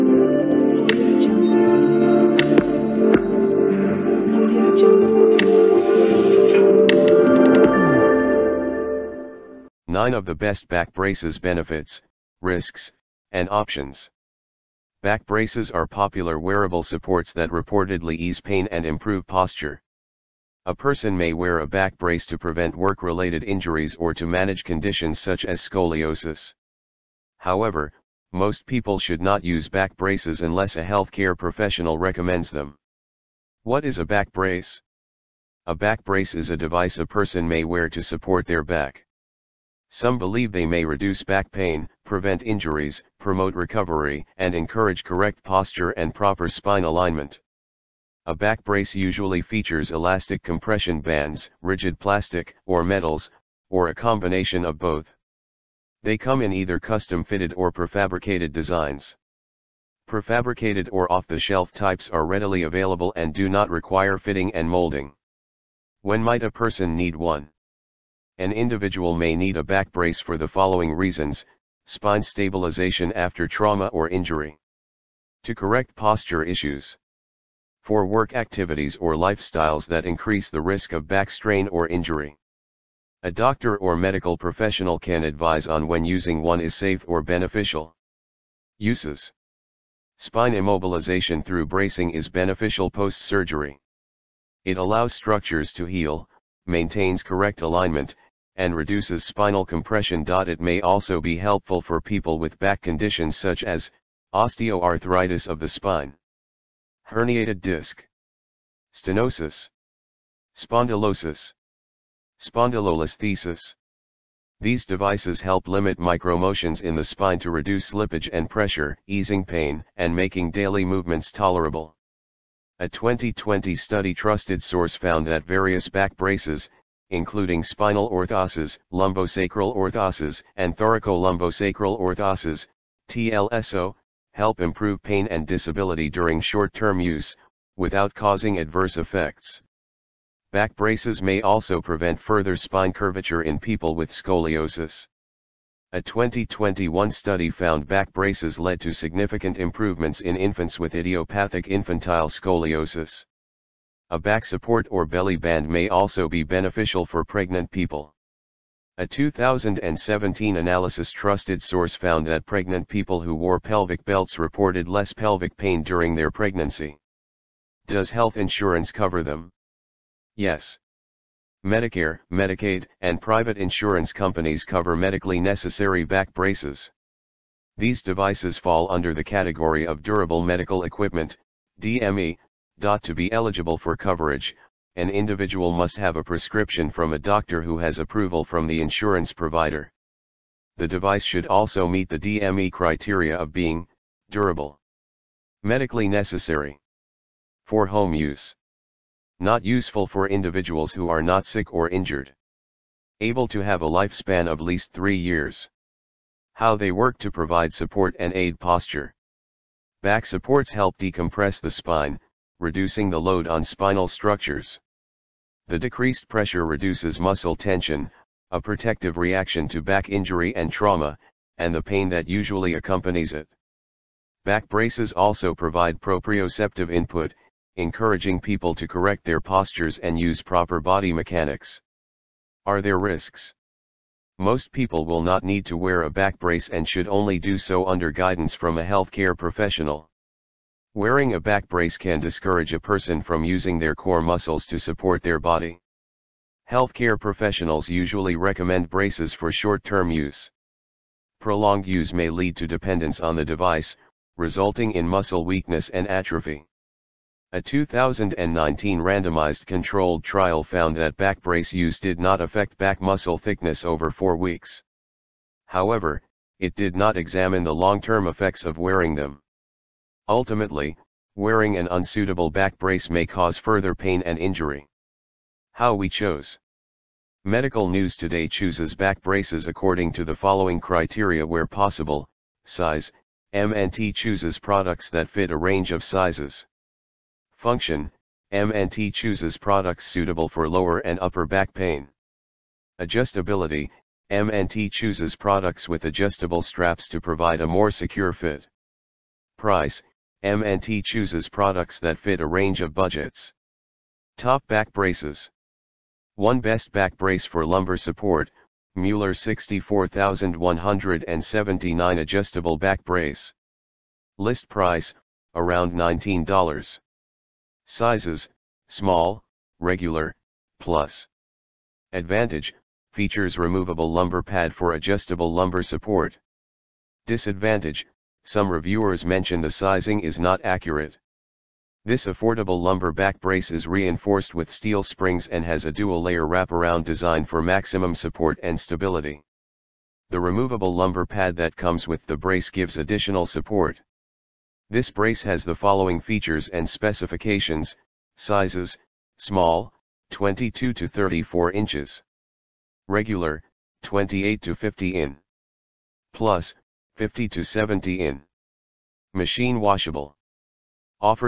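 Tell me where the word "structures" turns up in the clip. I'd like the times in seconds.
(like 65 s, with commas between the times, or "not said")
95 s, 214 s.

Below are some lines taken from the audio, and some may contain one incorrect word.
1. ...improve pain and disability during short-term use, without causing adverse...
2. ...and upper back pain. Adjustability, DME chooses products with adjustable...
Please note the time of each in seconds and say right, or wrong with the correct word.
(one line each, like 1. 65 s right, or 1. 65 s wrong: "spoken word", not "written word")
1. 134 s right
2. 290 s wrong: "MNT", not "DME".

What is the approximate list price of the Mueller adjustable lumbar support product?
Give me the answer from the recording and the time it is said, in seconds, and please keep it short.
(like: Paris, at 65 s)
$19, at 315 s.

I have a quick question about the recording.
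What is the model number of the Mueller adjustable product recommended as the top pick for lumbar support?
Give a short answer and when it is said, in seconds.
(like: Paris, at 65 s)
64179, at 309 s.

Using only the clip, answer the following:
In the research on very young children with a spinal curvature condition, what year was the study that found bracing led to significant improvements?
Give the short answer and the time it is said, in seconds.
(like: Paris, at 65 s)
2021, at 146 s.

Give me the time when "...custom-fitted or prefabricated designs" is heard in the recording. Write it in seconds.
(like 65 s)
56 s.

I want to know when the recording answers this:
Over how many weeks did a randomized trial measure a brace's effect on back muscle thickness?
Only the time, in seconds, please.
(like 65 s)
264 s.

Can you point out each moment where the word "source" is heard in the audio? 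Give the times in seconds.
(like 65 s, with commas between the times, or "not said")
124 s, 161 s.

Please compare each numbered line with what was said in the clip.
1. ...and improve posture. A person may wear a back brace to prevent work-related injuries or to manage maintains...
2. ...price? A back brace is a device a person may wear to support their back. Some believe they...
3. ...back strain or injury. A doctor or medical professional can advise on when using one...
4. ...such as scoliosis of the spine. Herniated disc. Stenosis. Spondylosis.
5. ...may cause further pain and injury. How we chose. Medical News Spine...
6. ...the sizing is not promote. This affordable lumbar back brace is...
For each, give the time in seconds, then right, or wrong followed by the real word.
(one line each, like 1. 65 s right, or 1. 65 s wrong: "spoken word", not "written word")
1. 18 s wrong: "conditions", not "maintains"
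2. 34 s wrong: "brace", not "price"
3. 81 s right
4. 103 s wrong: "osteoarthritis", not "scoliosis"
5. 273 s wrong: "Today", not "Spine"
6. 329 s wrong: "accurate", not "promote".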